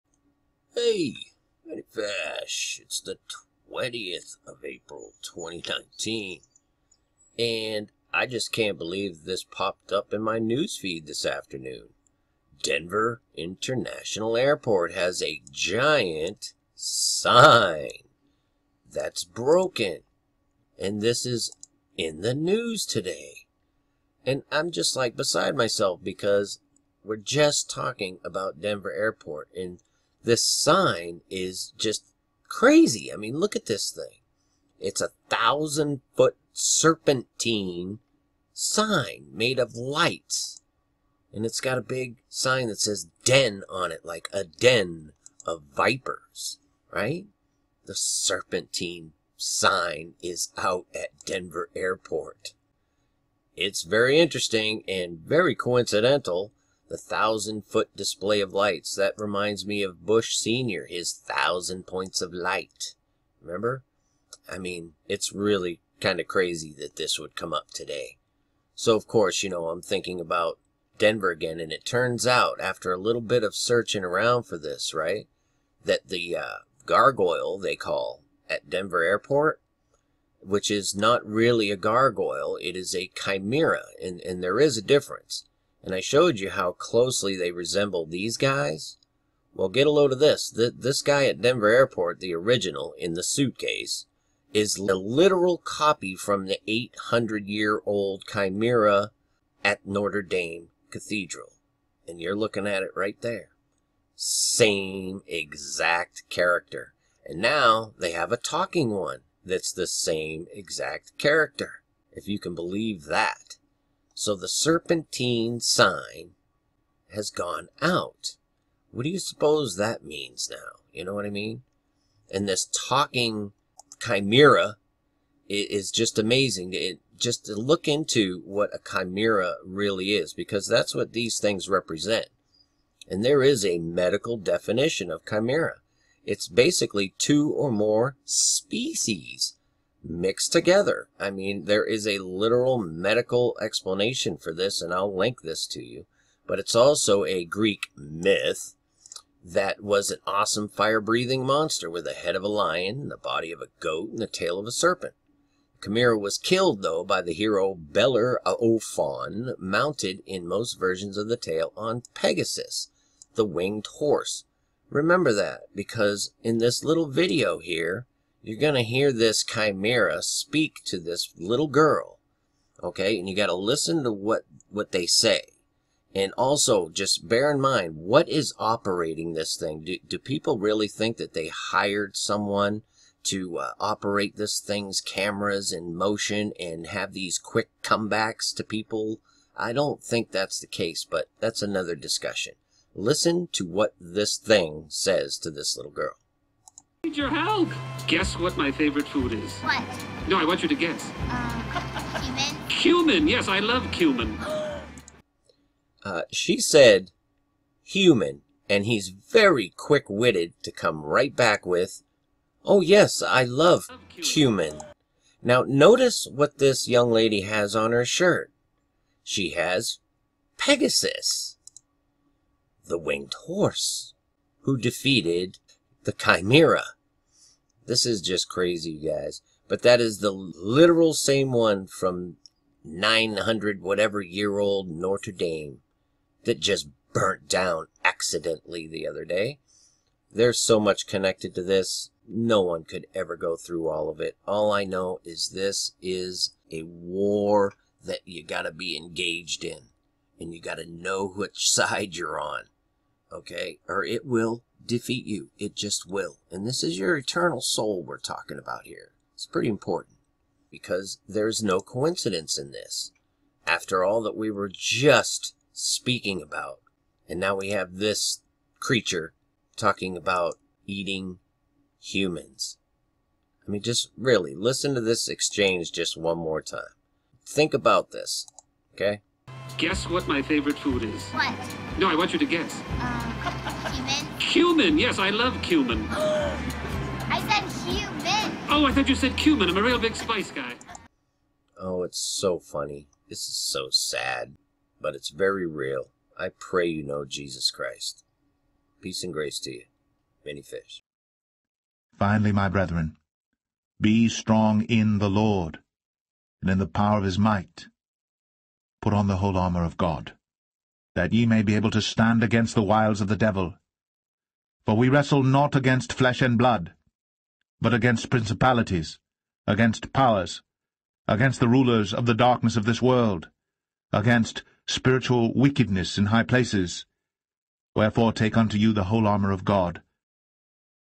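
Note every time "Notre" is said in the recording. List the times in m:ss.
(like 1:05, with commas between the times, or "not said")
1:39, 3:54.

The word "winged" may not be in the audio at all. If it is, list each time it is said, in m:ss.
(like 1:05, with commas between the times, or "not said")
2:43, 3:42.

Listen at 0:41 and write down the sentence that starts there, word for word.
And it's got a big sign that says den on it, like a den of vipers, right?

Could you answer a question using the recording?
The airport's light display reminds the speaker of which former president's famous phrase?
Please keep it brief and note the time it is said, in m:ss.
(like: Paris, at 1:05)
Bush Sr., at 1:00.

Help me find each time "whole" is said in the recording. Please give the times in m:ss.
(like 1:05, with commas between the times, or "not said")
5:09, 5:29.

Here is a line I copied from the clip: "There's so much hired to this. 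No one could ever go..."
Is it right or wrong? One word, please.
wrong.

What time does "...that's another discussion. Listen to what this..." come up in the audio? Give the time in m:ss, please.
3:11.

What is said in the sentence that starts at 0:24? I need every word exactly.
And I'm just like beside myself because we're just talking about Denver Airport and this sign is just crazy.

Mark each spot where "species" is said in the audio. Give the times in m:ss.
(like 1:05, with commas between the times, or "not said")
2:18.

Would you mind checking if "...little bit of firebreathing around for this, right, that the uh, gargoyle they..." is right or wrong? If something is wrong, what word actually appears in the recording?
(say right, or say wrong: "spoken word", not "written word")
wrong: "searching", not "firebreathing".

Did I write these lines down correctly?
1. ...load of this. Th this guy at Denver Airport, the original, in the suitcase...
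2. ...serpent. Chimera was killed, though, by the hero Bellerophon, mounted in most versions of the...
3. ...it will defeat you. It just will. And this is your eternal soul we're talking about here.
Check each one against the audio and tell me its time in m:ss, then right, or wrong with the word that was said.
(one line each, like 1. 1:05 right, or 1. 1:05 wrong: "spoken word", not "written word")
1. 1:29 right
2. 2:34 right
3. 4:14 right.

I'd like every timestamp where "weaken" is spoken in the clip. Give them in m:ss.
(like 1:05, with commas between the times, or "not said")
not said.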